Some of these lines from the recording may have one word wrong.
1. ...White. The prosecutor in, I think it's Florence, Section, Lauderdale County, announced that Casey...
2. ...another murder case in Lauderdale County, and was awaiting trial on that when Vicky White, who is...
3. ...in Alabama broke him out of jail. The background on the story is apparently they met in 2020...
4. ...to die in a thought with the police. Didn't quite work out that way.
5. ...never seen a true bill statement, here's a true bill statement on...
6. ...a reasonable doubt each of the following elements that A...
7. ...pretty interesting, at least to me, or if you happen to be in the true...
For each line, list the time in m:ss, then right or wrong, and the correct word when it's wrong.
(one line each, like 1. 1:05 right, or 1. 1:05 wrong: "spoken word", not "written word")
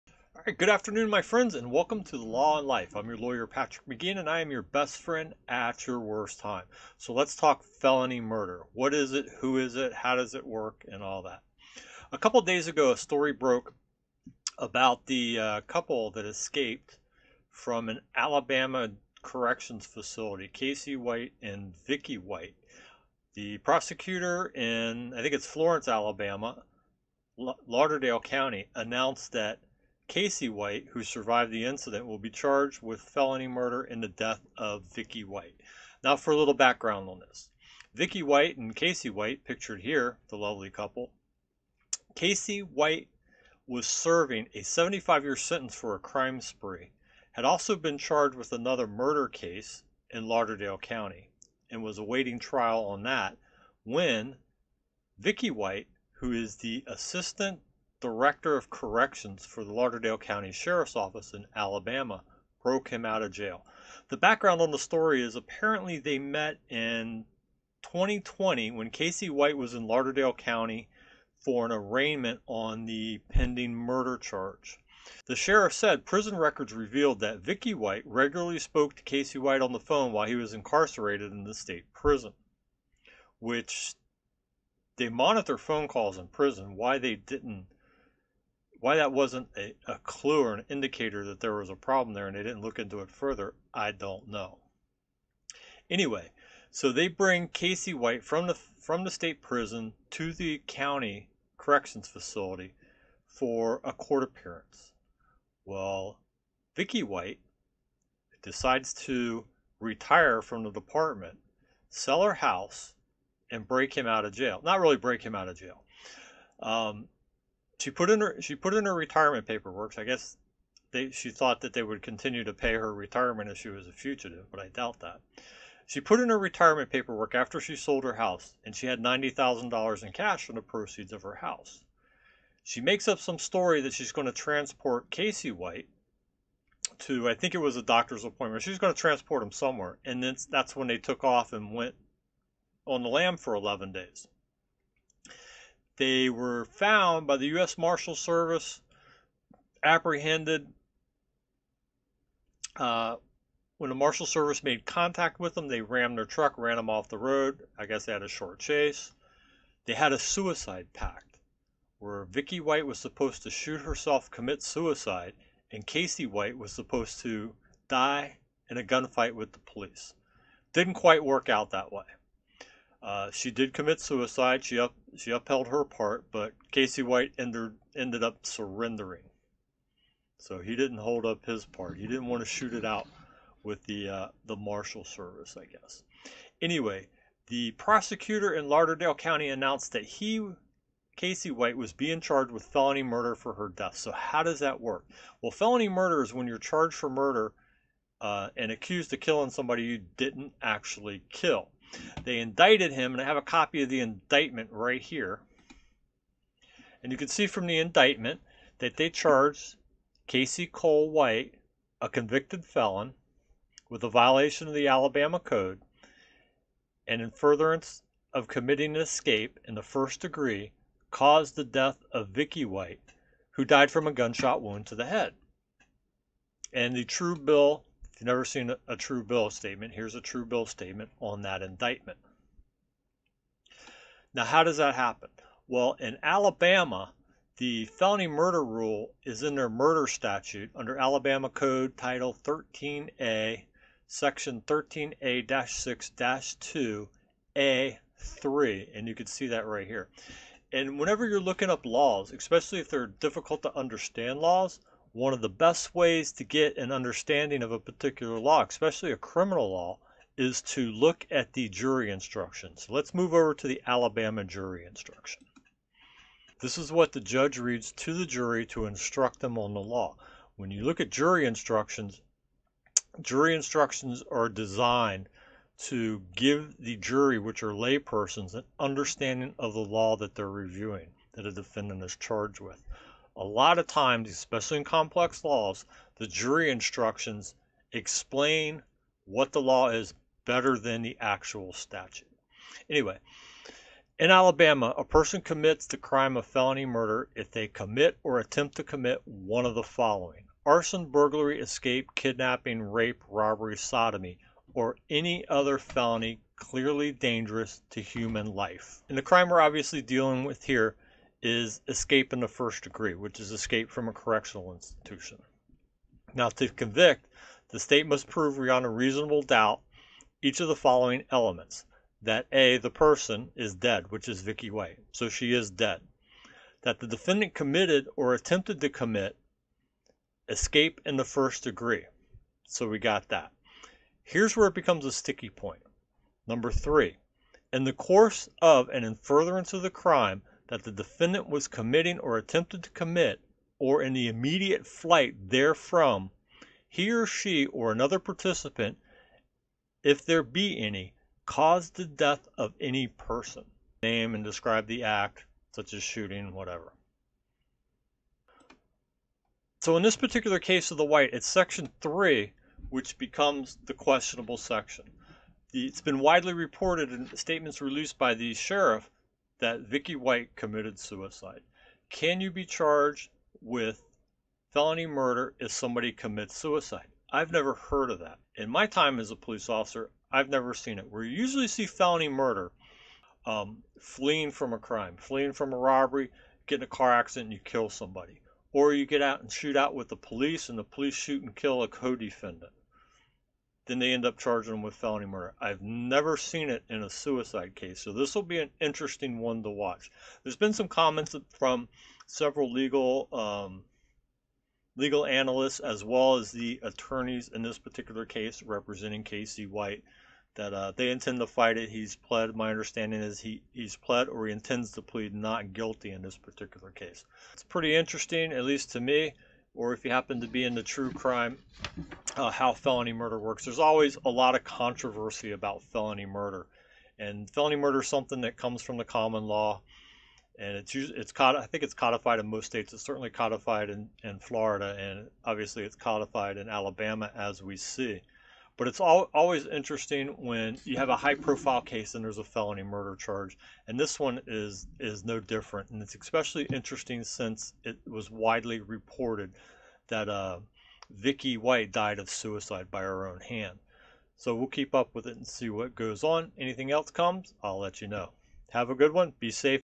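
1. 0:22 wrong: "Alabama", not "Section"
2. 0:48 right
3. 1:01 right
4. 2:47 wrong: "gunfight", not "thought"
5. 3:48 right
6. 5:18 right
7. 6:57 right.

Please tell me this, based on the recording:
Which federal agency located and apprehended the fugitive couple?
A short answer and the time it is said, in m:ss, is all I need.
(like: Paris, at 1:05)
U.S. Marshal Service, at 2:27.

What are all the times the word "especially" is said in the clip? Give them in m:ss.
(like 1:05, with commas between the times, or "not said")
4:12, 4:18, 4:44, 7:26.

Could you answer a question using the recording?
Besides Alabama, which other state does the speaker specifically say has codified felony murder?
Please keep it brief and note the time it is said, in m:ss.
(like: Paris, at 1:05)
Florida, at 7:14.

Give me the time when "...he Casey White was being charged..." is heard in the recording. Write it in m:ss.
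3:10.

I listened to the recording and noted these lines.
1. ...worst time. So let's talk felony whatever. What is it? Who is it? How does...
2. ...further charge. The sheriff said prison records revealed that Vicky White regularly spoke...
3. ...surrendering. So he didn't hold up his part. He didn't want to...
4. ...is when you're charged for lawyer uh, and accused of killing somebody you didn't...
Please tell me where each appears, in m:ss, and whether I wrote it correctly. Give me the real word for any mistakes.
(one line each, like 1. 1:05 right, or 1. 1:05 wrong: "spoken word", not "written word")
1. 0:05 wrong: "murder", not "whatever"
2. 1:13 wrong: "murder", not "further"
3. 2:58 right
4. 3:16 wrong: "murder", not "lawyer".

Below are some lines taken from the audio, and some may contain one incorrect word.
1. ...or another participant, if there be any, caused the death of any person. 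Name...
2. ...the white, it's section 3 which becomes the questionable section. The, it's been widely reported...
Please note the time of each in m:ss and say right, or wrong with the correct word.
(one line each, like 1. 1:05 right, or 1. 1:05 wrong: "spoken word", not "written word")
1. 5:47 right
2. 6:00 right.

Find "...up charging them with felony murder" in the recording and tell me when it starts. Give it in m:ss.
6:34.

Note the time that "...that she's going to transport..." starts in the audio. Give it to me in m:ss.
2:13.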